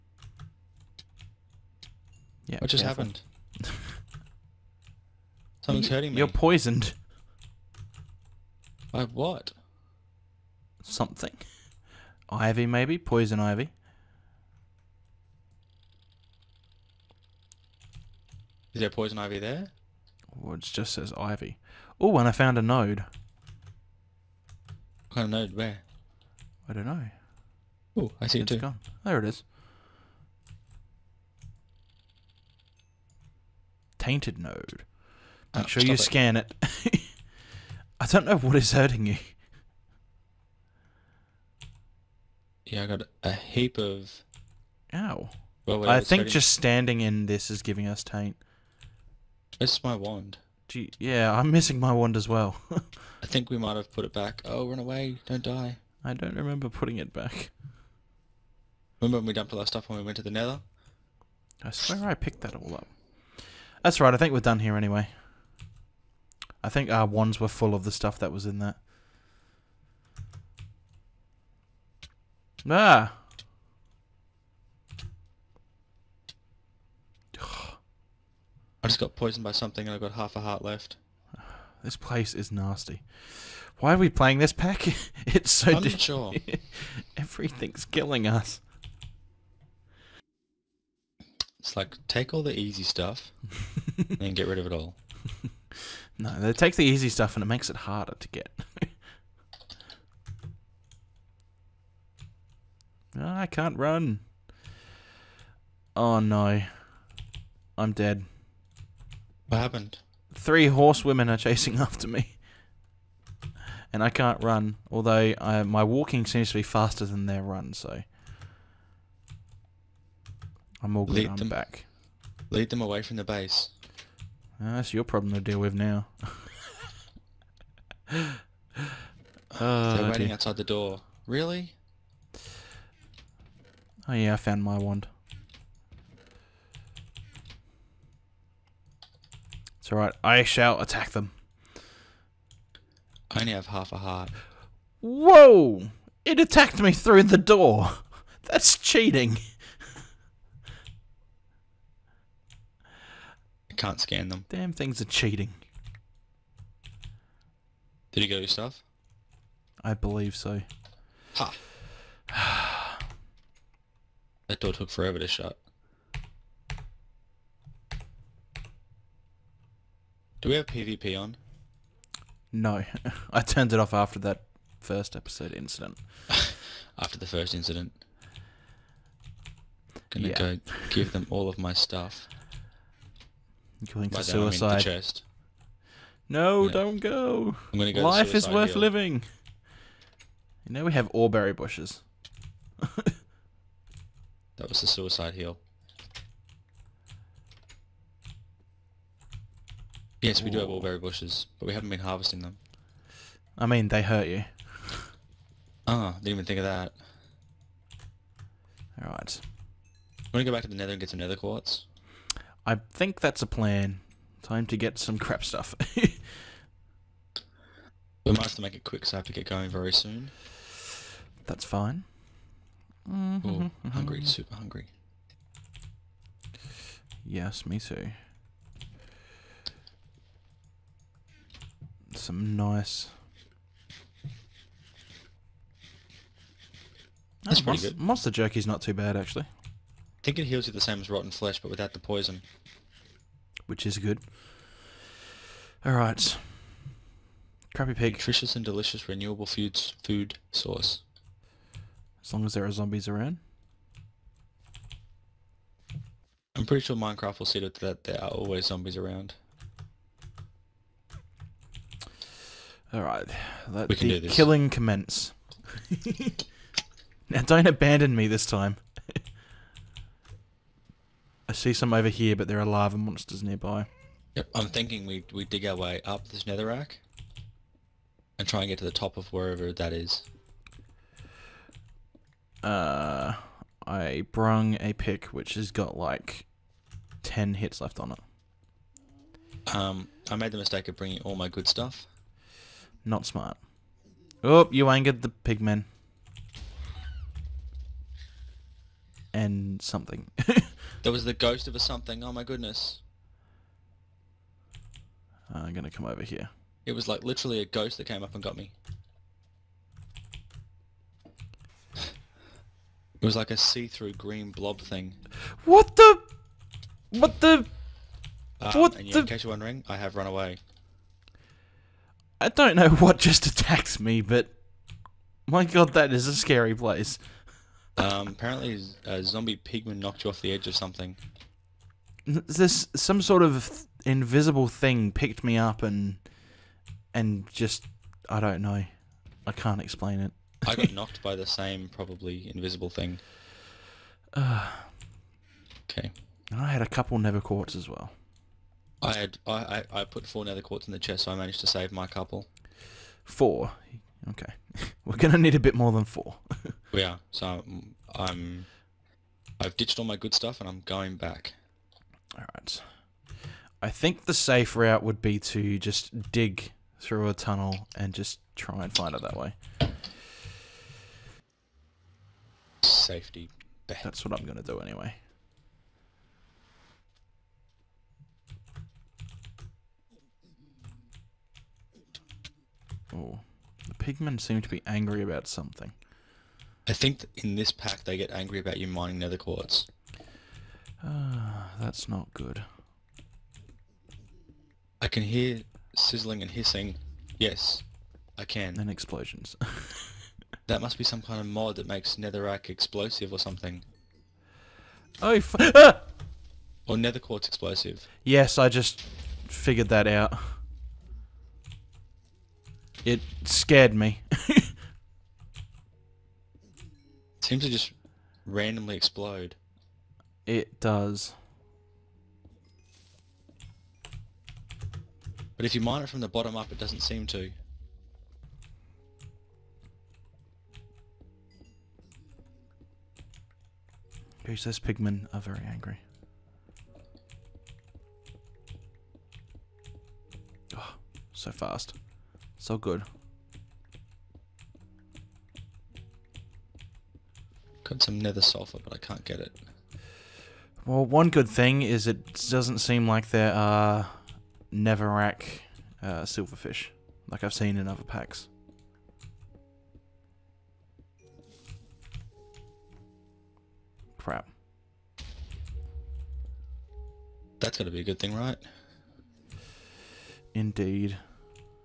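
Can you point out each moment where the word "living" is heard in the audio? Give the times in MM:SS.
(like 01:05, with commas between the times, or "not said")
03:08.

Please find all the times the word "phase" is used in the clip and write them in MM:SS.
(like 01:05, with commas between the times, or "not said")
not said.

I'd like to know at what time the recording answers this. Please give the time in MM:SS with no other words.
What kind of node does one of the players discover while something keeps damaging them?
00:33.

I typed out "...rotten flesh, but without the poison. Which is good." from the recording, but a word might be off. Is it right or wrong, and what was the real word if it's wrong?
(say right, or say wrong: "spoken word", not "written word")
right.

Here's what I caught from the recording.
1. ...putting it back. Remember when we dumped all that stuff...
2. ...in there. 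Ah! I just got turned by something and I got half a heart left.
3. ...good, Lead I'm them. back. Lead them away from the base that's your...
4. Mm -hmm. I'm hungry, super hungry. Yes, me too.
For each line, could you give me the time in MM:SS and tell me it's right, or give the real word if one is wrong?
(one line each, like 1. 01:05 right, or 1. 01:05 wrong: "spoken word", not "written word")
1. 00:56 right
2. 01:08 wrong: "poisoned", not "turned"
3. 02:01 right
4. 03:43 right.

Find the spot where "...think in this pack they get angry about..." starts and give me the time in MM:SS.
06:26.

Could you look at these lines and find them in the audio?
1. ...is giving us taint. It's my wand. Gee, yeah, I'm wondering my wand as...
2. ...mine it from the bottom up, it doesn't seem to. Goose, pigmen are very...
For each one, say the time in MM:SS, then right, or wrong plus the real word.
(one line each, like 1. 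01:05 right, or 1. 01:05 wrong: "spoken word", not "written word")
1. 00:47 wrong: "missing", not "wondering"
2. 07:05 right.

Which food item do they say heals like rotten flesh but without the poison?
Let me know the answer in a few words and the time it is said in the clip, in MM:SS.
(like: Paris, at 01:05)
Monster jerky, at 03:58.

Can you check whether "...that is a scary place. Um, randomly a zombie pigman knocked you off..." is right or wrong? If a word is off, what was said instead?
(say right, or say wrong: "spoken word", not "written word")
wrong: "apparently", not "randomly".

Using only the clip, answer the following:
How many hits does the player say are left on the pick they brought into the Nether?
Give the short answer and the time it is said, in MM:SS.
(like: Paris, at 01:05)
10, at 04:47.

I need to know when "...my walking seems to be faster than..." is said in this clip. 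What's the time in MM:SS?
01:55.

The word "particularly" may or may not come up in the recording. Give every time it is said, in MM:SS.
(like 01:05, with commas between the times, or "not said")
not said.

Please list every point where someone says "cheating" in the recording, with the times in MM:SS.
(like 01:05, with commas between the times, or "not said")
02:28, 02:35.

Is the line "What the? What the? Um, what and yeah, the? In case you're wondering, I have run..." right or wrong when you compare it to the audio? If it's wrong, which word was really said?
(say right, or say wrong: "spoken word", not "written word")
right.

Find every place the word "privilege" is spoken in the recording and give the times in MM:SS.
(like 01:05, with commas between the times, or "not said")
not said.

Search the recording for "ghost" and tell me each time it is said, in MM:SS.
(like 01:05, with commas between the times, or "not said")
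05:01, 05:07.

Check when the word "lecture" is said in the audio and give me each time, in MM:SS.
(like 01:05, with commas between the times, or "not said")
not said.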